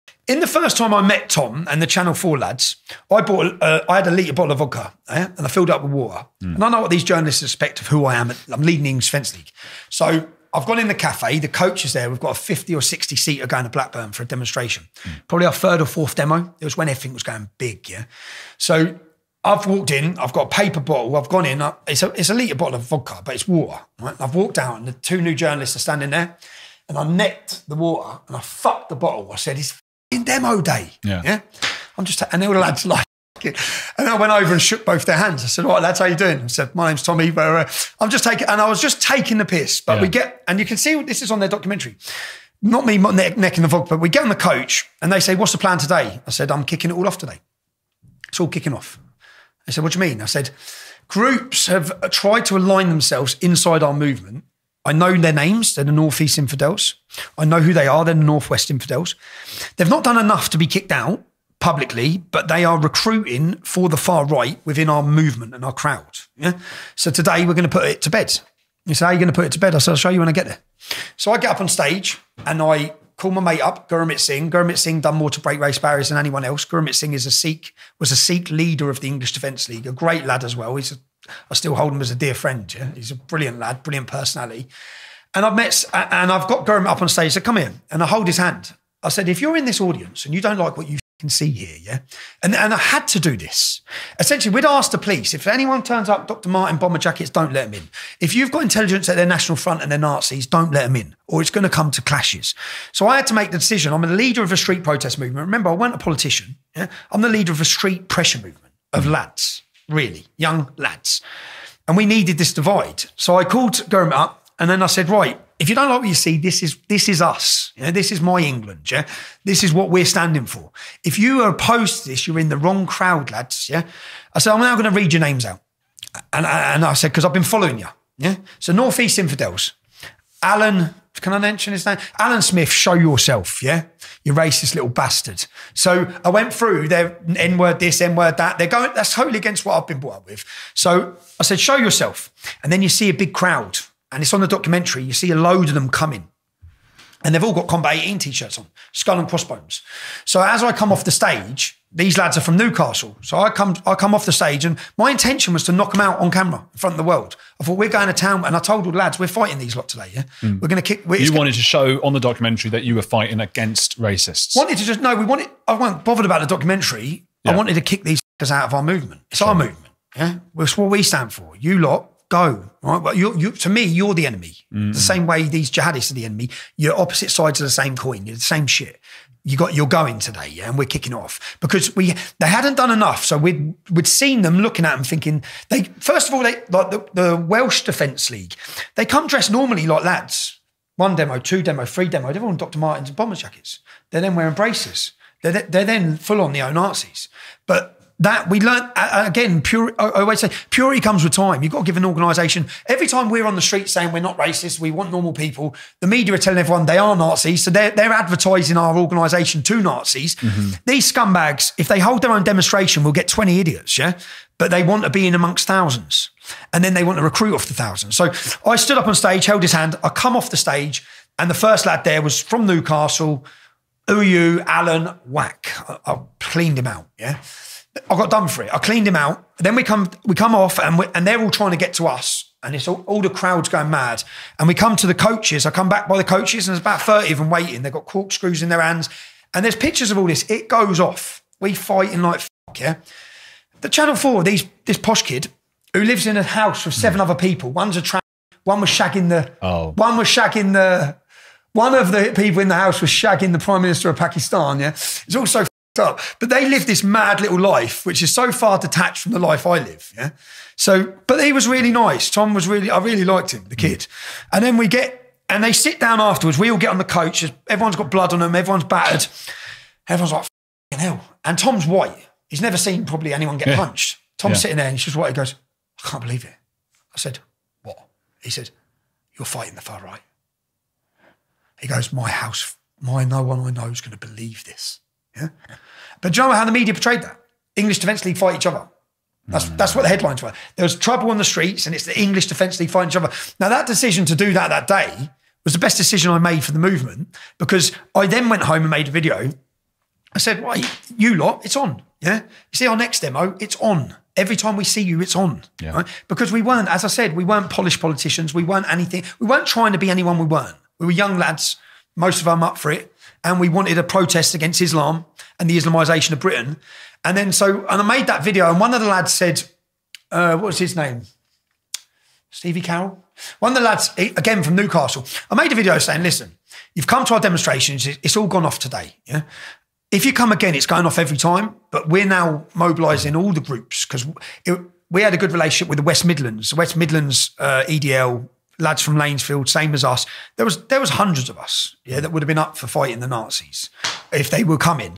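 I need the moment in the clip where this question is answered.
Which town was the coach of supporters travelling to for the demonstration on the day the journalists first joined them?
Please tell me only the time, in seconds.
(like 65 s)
13 s.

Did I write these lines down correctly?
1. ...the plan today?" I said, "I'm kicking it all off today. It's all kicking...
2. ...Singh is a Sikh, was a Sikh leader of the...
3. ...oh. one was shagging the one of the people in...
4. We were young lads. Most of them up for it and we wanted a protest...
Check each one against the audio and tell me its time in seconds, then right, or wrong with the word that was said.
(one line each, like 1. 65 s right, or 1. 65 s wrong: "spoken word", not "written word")
1. 45 s right
2. 76 s right
3. 249 s right
4. 310 s right.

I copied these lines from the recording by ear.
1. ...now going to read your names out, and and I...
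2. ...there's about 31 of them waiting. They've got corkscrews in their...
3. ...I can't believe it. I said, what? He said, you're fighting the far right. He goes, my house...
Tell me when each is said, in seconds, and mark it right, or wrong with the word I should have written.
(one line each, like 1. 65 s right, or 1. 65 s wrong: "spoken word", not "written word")
1. 124 s right
2. 236 s wrong: "30", not "31"
3. 276 s right.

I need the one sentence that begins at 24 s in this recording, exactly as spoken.
I've walked out and the two new journalists are standing there and I necked the water and I fucked the bottle.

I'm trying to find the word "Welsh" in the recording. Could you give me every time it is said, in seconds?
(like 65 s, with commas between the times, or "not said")
187 s.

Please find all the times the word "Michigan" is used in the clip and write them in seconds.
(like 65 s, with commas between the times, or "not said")
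not said.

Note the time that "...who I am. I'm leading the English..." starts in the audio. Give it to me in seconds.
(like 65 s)
7 s.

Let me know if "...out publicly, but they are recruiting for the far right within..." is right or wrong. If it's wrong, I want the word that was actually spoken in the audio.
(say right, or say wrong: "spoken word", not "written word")
right.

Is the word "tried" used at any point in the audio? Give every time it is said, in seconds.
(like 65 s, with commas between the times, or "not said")
52 s.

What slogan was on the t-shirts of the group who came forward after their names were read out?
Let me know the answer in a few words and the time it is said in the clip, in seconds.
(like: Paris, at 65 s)
Combat 18, at 147 s.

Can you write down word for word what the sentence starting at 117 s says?
You know, this is my England.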